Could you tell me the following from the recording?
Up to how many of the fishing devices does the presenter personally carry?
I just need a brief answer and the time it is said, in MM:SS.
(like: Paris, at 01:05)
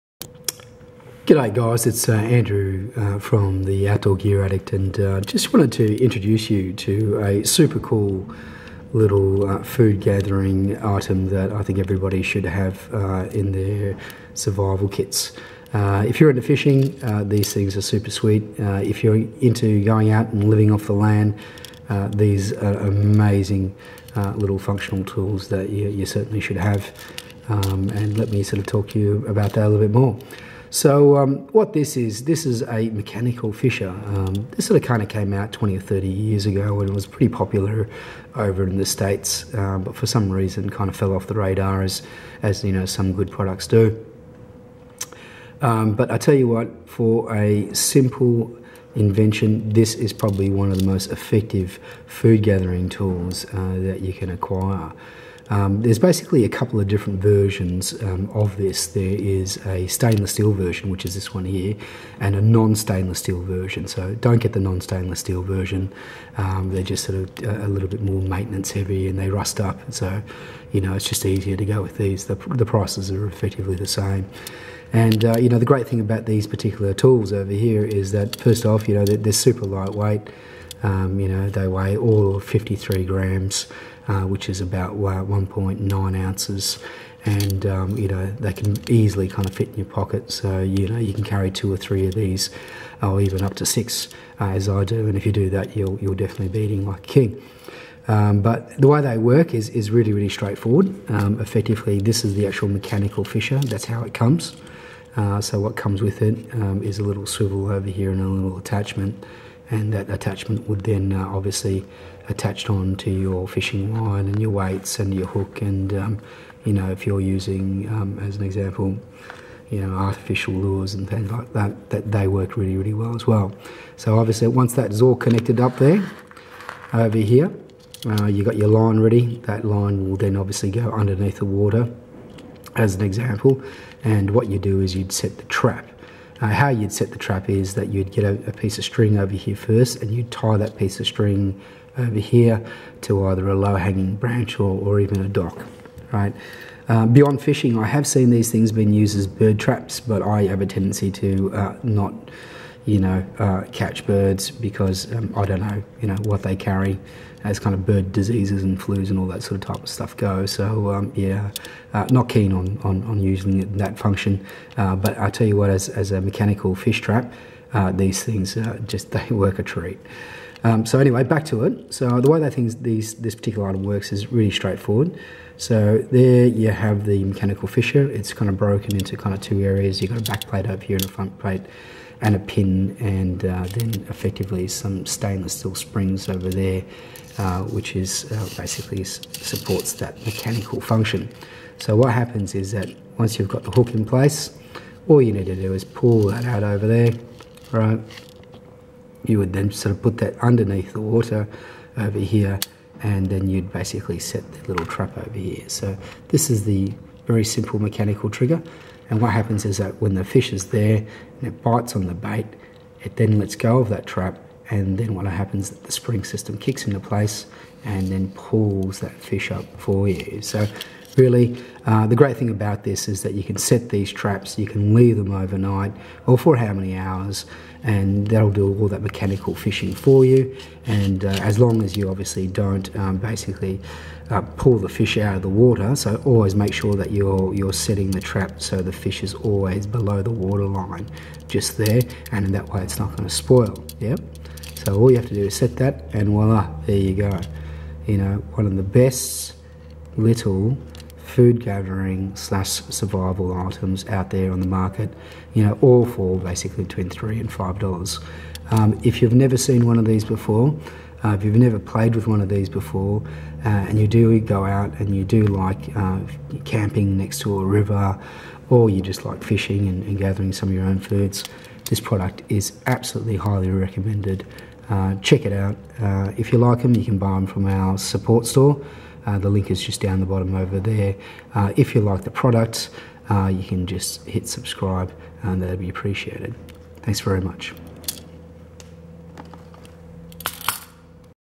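6, at 01:33.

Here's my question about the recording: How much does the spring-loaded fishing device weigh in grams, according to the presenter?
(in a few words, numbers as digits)
53 grams.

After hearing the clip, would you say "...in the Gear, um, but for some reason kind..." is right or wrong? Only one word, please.
wrong.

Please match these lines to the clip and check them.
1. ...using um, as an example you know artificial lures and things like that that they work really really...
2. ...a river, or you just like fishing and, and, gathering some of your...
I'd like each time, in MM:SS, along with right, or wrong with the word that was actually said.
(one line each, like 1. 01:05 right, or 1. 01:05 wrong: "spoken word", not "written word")
1. 01:57 right
2. 04:27 right.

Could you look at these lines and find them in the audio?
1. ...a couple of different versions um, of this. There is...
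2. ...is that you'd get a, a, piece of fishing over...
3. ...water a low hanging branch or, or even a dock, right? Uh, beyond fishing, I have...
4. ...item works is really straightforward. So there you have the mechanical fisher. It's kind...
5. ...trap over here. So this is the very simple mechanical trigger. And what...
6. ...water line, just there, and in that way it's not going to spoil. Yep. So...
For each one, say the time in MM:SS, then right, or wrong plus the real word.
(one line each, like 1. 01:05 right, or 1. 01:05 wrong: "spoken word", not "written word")
1. 00:56 right
2. 02:17 wrong: "string", not "fishing"
3. 02:23 wrong: "either", not "water"
4. 02:53 right
5. 03:24 right
6. 04:00 right.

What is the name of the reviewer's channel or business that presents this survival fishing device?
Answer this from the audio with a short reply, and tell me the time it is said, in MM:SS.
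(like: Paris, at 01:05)
Outdoor Gear Addict, at 00:03.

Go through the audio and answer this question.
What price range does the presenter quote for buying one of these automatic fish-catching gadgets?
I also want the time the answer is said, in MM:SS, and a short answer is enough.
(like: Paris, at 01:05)
$3 to $5, at 04:16.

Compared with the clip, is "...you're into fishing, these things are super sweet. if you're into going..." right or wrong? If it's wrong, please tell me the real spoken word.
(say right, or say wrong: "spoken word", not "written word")
right.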